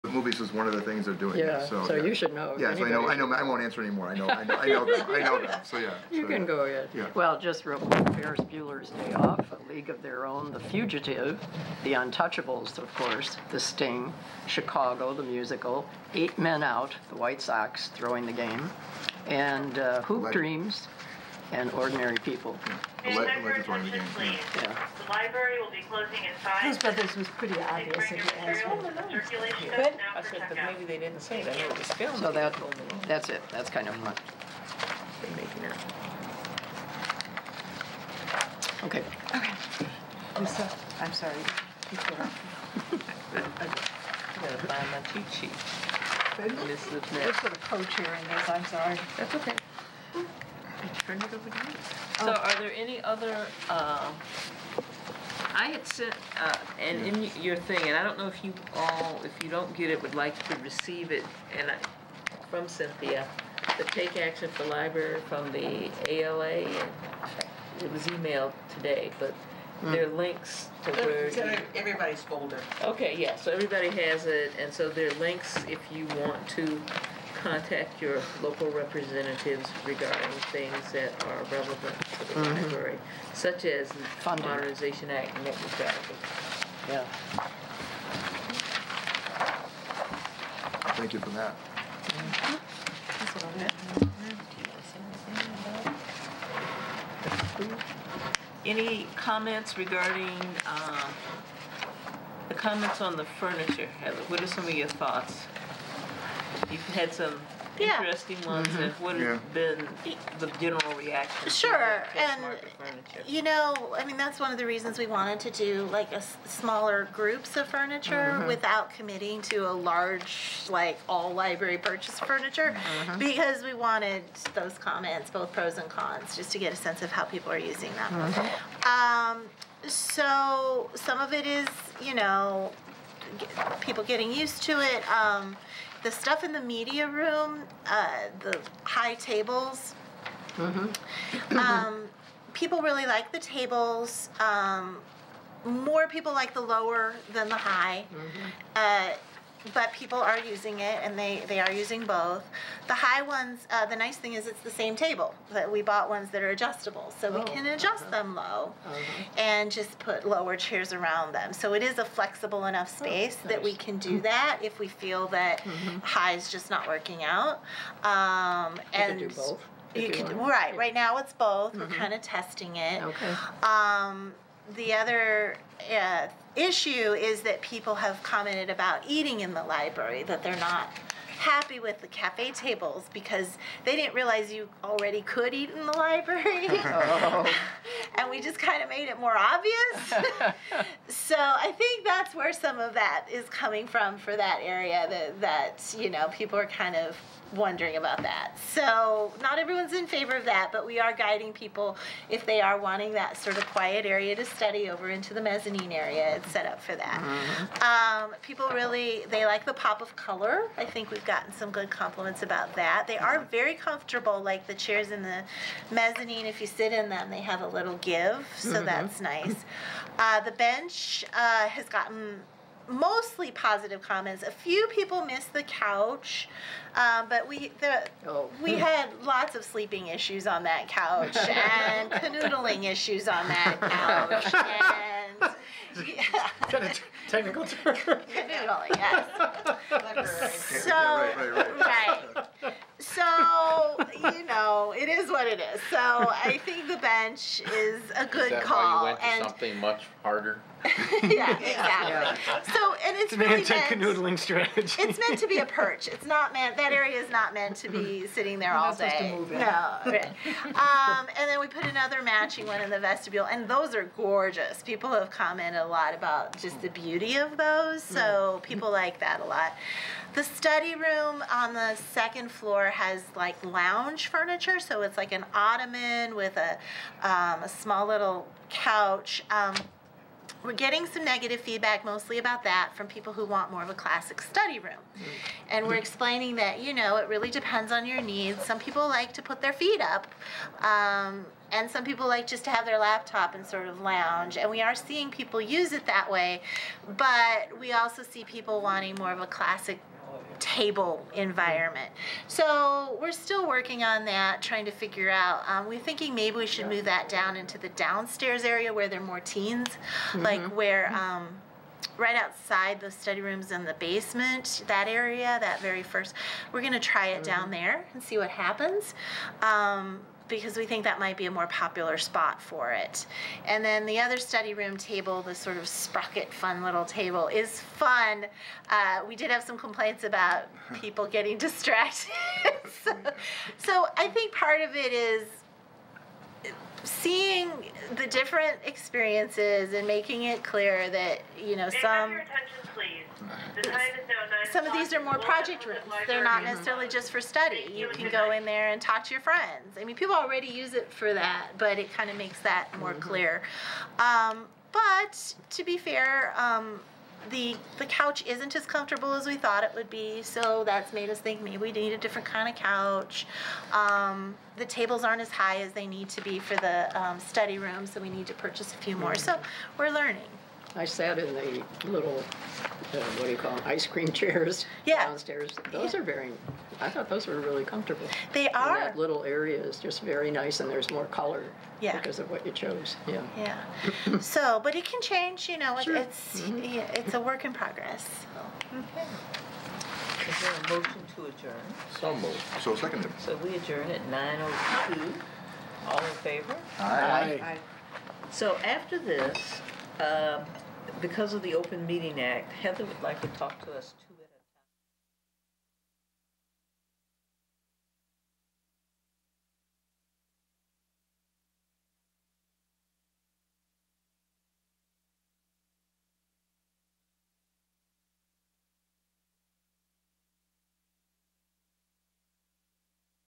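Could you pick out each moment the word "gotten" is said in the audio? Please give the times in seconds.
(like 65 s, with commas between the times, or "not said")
211 s, 221 s.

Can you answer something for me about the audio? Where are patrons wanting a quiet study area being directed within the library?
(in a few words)
The mezzanine area.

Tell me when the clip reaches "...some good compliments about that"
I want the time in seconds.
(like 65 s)
211 s.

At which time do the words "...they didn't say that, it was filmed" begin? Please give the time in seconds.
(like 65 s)
30 s.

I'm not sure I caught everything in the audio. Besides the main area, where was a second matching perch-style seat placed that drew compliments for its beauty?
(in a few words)
The vestibule.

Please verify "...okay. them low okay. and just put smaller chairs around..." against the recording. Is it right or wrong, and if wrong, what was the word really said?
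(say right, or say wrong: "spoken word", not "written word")
wrong: "lower", not "smaller".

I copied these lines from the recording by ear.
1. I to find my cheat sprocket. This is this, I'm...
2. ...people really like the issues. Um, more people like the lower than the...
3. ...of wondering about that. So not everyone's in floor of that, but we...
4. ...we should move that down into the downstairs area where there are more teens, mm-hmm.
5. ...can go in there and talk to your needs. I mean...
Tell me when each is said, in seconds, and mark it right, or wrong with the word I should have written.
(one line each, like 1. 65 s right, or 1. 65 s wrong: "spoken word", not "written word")
1. 43 s wrong: "sheet", not "sprocket"
2. 142 s wrong: "tables", not "issues"
3. 196 s wrong: "favor", not "floor"
4. 306 s right
5. 348 s wrong: "friends", not "needs".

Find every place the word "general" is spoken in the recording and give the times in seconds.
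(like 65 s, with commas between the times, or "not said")
110 s.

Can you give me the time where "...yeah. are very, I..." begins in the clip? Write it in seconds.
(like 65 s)
376 s.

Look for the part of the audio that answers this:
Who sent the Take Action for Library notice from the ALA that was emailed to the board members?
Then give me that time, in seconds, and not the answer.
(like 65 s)
62 s.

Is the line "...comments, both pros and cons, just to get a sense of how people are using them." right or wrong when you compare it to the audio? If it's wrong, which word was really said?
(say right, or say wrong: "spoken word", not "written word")
right.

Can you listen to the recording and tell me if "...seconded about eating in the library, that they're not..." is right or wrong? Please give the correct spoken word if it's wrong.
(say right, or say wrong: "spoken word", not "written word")
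wrong: "commented", not "seconded".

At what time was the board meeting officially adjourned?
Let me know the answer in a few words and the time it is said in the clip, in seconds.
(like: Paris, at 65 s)
9:02, at 394 s.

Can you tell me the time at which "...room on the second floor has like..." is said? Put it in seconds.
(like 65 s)
270 s.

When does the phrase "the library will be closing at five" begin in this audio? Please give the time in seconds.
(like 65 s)
23 s.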